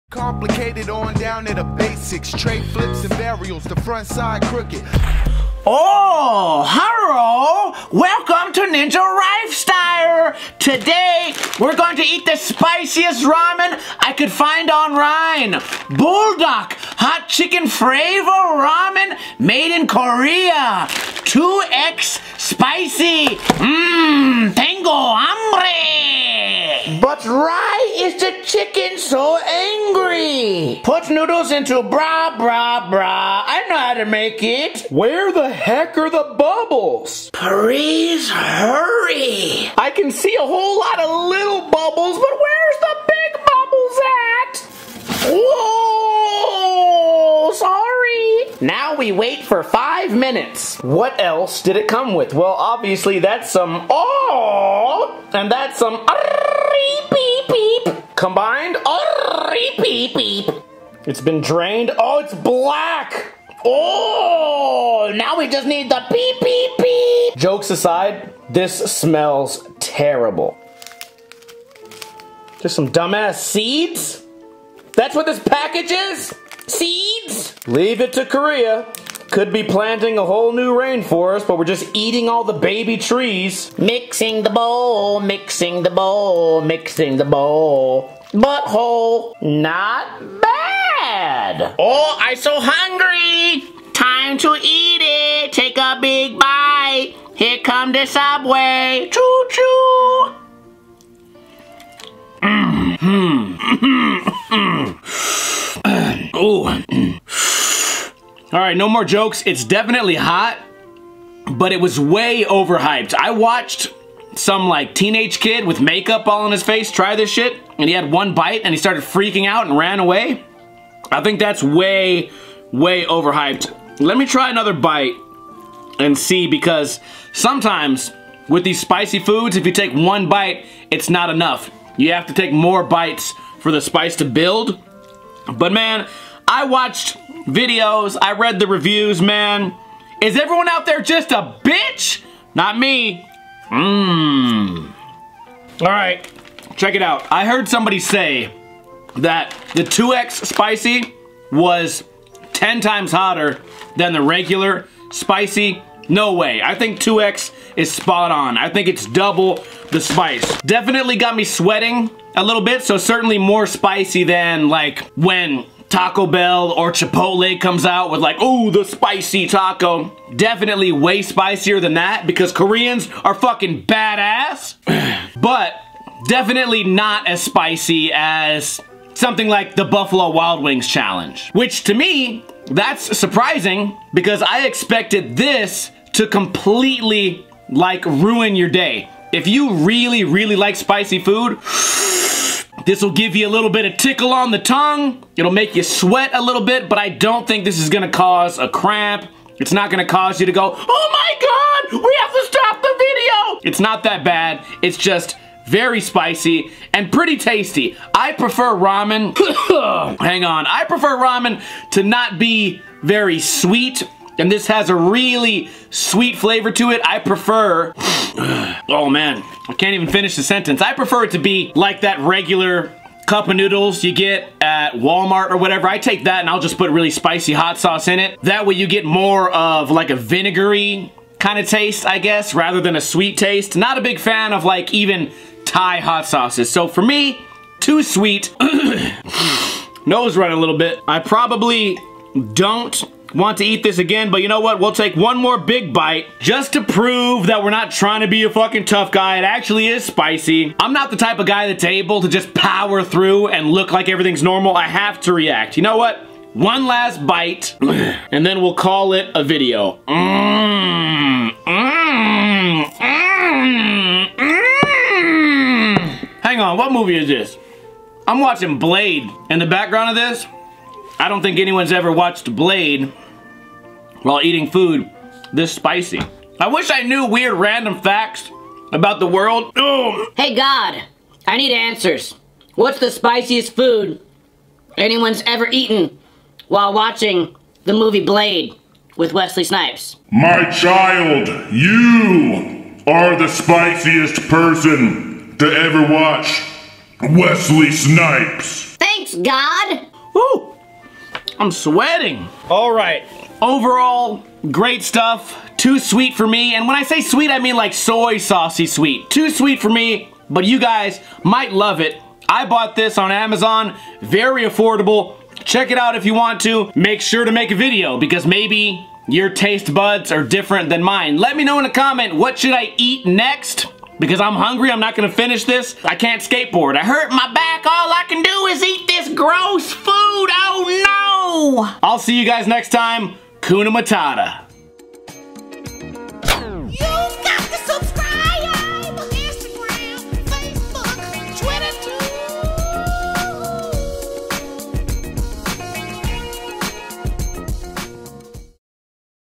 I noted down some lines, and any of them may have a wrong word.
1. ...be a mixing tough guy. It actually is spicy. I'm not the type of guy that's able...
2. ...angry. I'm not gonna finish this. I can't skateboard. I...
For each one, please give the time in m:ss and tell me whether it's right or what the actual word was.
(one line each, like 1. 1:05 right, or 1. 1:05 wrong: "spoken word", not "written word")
1. 4:08 wrong: "fucking", not "mixing"
2. 5:24 wrong: "hungry", not "angry".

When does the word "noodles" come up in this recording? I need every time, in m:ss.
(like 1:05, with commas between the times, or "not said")
0:31, 3:43.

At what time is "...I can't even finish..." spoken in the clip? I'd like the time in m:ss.
3:39.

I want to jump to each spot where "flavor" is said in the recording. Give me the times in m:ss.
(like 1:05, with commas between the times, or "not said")
0:17, 3:36.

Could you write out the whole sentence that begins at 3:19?
It's not gonna cause you to go, oh my God, we have to stop the video.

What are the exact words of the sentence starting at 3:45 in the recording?
I take that and I'll just put really spicy hot sauce in it.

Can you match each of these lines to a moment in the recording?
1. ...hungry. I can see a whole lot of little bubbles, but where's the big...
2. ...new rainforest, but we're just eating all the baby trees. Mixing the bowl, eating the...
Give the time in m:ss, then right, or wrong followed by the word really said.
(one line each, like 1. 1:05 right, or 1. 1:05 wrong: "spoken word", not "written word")
1. 0:38 wrong: "hurry", not "hungry"
2. 1:20 wrong: "mixing", not "eating".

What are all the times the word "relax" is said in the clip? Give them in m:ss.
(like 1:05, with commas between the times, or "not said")
not said.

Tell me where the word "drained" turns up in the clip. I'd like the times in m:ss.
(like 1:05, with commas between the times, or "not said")
1:01.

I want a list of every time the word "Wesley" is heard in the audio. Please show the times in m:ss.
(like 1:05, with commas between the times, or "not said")
4:49, 4:57.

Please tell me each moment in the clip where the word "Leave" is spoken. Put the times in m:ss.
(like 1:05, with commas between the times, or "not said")
1:17.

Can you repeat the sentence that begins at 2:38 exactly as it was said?
I think it's double the spice.